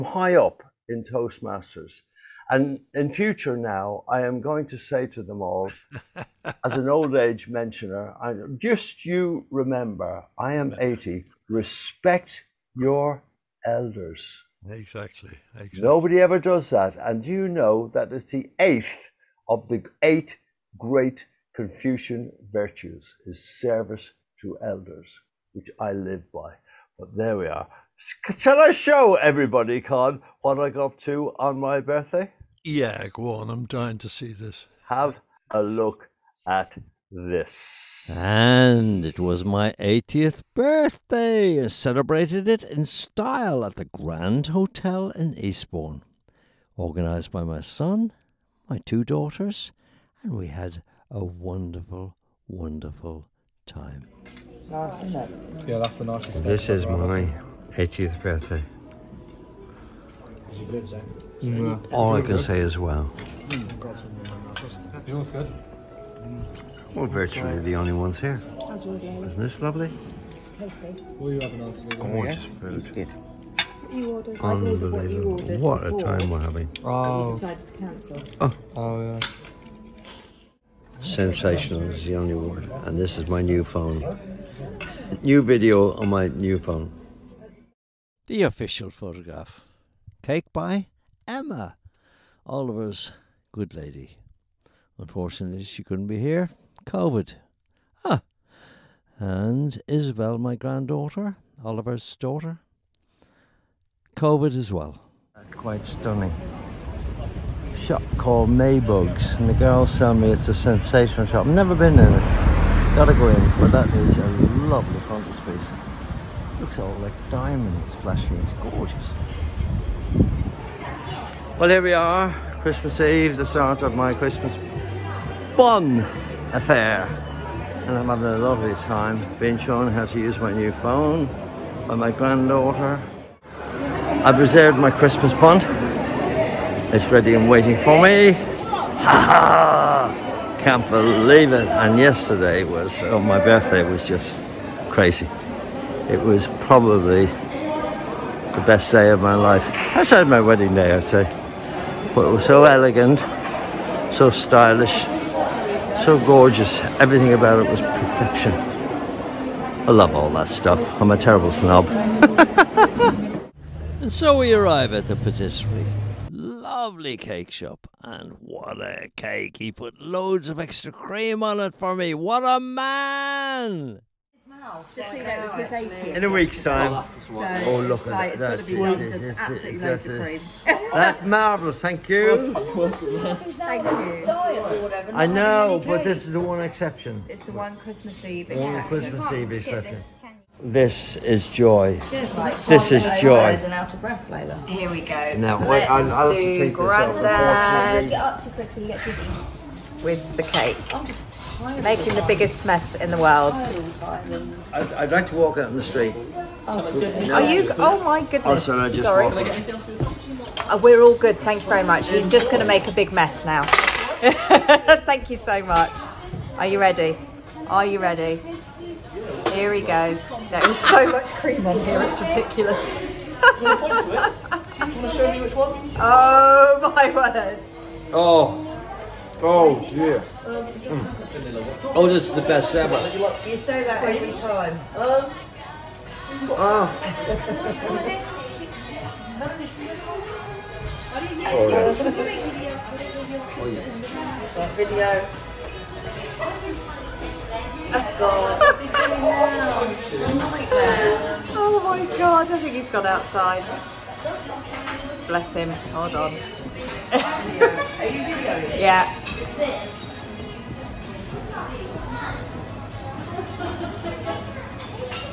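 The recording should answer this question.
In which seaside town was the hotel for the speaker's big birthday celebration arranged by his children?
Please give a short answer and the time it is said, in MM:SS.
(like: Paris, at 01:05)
Eastbourne, at 00:45.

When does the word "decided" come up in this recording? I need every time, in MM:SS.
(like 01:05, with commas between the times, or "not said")
01:17.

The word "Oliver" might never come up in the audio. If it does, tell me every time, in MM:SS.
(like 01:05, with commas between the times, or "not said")
01:32, 01:41.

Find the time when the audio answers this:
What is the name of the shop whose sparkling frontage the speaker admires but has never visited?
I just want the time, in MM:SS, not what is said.
01:48.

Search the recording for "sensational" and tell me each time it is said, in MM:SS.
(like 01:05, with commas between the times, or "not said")
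01:21, 01:50.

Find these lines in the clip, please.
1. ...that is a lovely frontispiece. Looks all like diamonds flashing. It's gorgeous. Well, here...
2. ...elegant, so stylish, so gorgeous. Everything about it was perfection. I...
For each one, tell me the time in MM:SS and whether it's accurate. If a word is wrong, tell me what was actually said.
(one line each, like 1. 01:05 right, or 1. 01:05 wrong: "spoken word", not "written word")
1. 01:53 right
2. 02:32 right.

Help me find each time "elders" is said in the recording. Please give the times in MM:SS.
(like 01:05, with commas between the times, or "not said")
00:13, 00:24.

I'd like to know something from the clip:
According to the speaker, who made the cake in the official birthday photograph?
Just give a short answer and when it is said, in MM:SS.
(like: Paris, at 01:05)
Emma, at 01:31.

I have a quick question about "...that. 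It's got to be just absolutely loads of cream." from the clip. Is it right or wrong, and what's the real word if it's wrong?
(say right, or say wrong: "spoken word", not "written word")
right.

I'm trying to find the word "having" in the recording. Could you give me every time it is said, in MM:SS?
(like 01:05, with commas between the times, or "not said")
01:16, 02:08.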